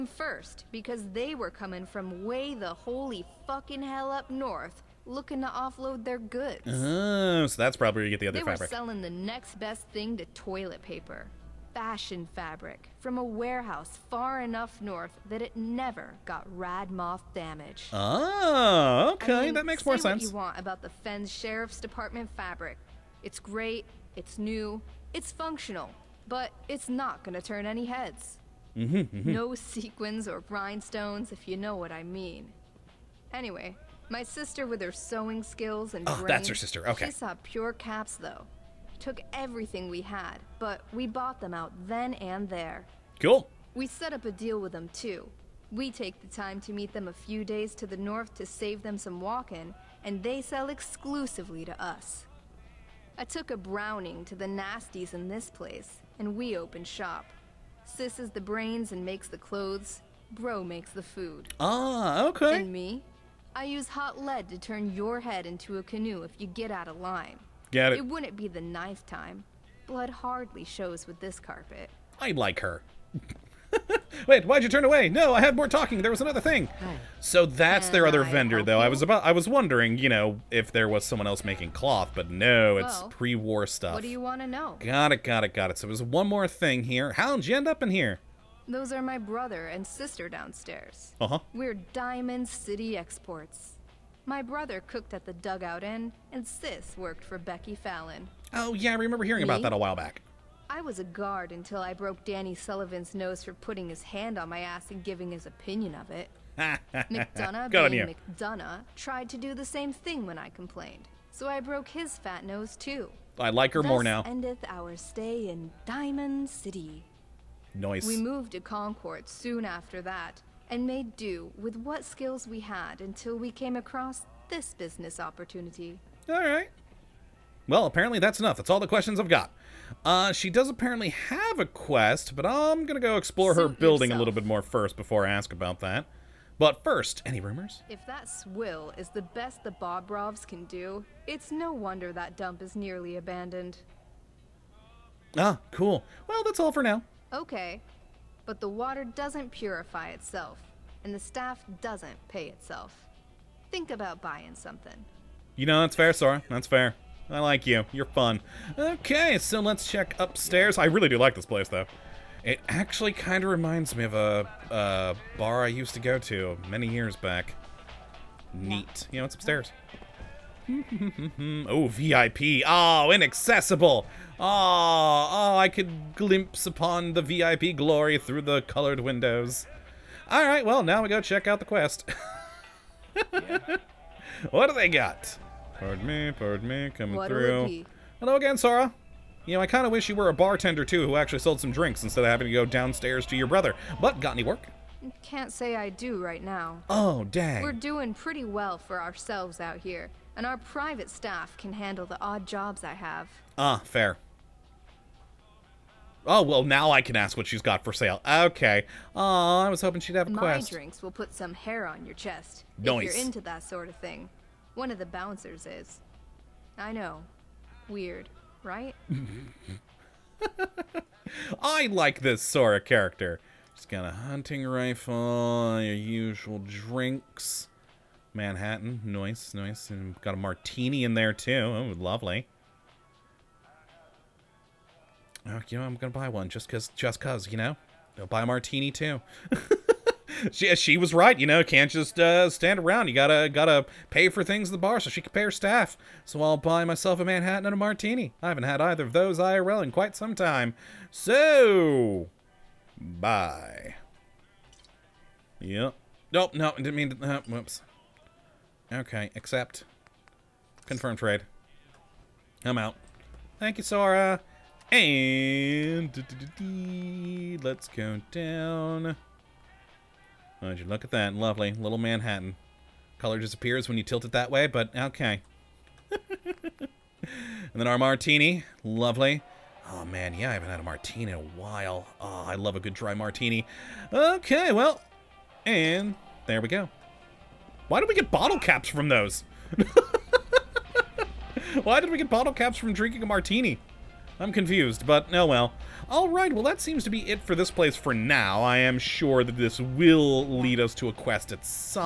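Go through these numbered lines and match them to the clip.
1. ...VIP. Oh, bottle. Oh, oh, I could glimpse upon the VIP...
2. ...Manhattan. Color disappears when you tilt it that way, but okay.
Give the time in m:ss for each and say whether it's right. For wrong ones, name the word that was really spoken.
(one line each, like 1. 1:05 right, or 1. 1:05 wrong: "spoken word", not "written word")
1. 2:51 wrong: "inaccessible", not "bottle"
2. 4:31 right.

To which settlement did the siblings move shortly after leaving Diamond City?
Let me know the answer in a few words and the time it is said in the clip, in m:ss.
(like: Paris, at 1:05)
Concord, at 1:58.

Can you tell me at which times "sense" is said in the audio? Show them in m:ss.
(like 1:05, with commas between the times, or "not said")
0:19.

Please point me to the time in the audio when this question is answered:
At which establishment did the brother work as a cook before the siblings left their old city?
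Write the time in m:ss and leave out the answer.
1:35.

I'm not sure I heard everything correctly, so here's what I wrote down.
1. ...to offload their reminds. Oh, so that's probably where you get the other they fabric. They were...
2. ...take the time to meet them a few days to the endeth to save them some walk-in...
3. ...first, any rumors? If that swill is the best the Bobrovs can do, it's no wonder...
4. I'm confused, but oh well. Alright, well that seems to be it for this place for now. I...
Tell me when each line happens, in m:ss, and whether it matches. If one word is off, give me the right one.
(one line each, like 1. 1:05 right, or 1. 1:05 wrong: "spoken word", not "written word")
1. 0:05 wrong: "goods", not "reminds"
2. 0:45 wrong: "north", not "endeth"
3. 2:16 right
4. 4:54 right.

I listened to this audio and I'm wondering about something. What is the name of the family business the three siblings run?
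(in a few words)
Diamond City Exports.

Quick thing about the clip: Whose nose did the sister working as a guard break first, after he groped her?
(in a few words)
Danny Sullivan.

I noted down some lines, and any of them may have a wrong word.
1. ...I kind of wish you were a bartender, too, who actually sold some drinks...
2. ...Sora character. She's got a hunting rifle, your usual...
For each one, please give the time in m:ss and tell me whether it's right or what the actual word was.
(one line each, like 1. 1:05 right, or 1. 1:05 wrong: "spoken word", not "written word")
1. 3:09 right
2. 3:42 right.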